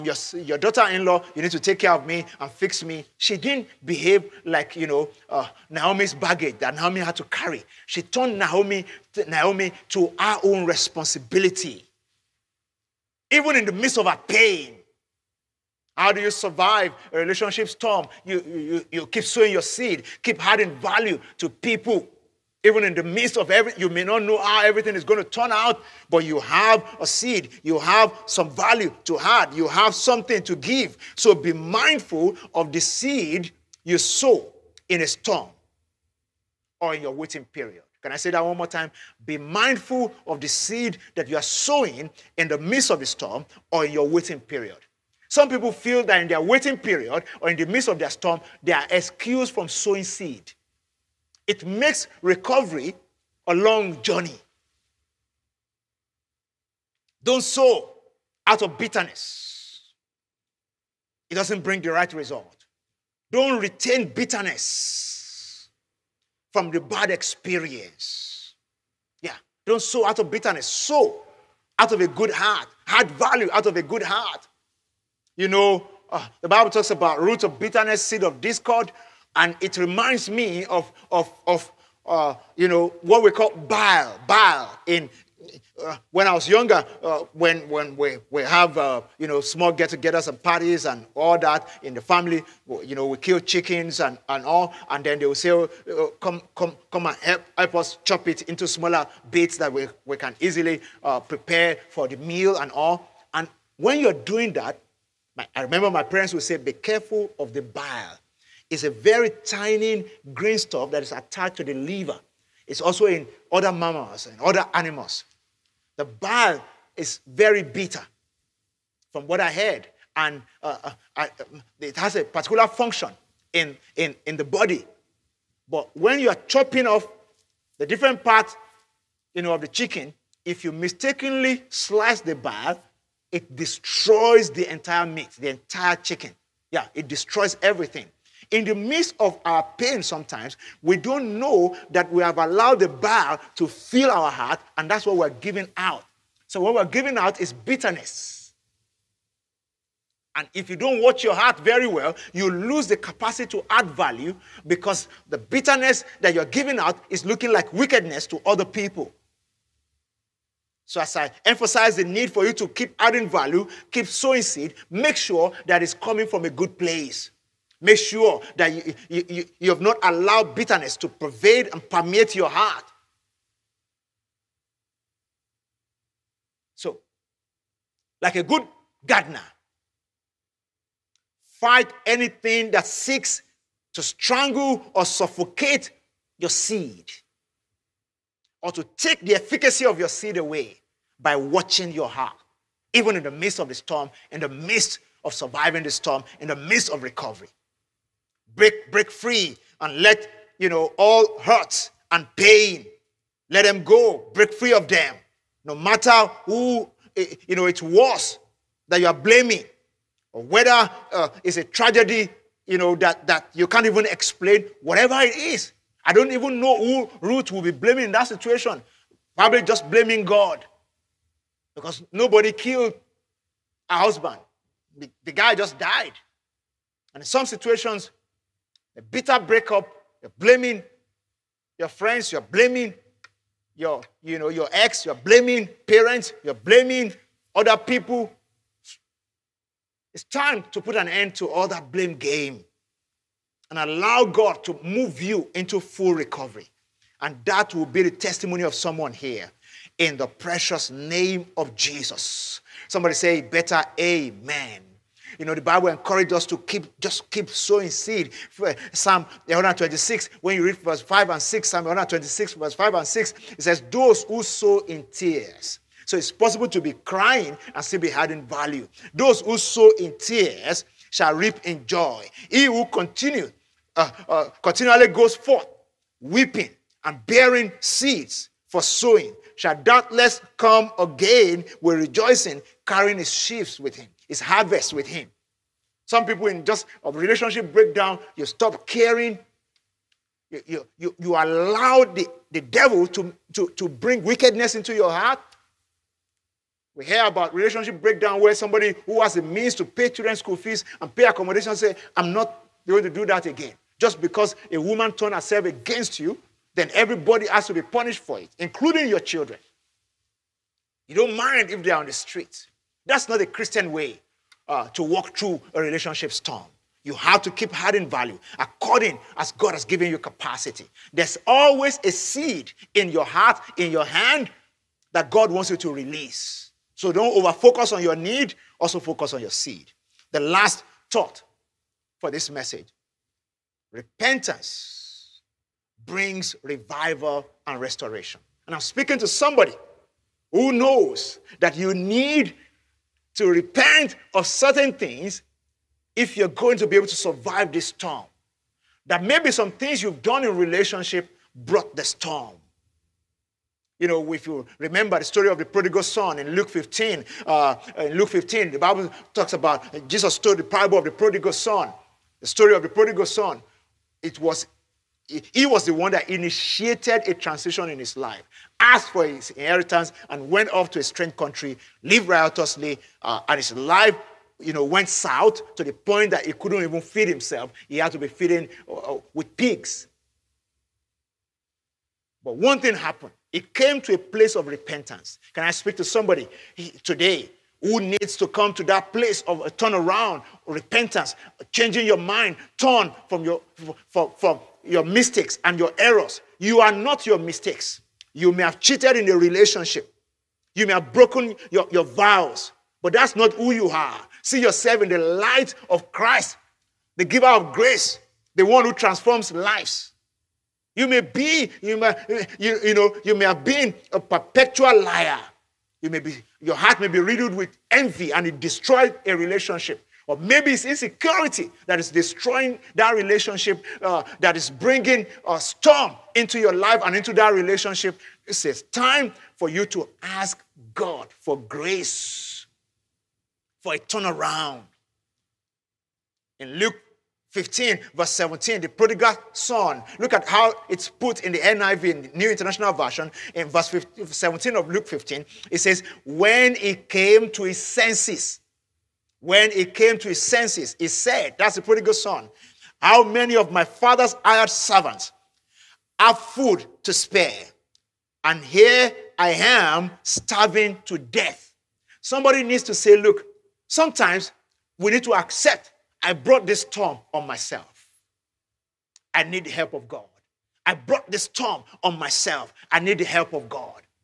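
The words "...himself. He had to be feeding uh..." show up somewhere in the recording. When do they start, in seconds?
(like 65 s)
377 s.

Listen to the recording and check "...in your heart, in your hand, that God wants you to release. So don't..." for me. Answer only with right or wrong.
right.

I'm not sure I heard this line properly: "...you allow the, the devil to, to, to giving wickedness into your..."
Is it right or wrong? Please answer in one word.
wrong.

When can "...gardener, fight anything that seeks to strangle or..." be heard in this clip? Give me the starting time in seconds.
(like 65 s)
179 s.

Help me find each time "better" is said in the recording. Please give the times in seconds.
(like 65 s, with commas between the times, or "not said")
253 s.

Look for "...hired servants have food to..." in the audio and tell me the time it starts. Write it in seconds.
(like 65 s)
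454 s.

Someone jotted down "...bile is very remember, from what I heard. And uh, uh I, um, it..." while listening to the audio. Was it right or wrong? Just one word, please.
wrong.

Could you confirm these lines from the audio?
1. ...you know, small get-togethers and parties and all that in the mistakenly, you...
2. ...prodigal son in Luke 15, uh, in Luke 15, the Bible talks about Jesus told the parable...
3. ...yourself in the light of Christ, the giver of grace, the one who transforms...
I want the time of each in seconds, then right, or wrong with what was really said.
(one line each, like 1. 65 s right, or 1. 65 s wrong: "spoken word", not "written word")
1. 89 s wrong: "family", not "mistakenly"
2. 355 s right
3. 404 s right.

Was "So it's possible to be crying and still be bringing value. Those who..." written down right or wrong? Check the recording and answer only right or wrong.
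wrong.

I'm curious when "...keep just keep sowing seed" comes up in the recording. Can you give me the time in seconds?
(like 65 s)
256 s.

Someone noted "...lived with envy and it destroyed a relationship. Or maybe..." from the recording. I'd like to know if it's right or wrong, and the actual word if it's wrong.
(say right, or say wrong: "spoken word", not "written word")
wrong: "riddled", not "lived".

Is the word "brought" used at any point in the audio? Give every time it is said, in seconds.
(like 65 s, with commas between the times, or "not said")
351 s, 466 s, 470 s.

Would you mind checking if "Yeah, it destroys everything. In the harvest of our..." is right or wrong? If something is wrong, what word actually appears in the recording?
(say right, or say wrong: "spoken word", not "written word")
wrong: "midst", not "harvest".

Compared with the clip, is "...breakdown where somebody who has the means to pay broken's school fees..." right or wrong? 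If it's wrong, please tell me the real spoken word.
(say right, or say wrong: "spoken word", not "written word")
wrong: "children", not "broken".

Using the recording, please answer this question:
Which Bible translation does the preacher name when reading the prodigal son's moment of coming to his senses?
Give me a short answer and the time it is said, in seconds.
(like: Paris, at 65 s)
New International Version, at 442 s.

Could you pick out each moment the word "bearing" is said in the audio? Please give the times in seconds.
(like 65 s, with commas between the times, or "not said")
277 s.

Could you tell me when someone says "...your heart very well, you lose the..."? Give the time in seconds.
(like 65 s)
151 s.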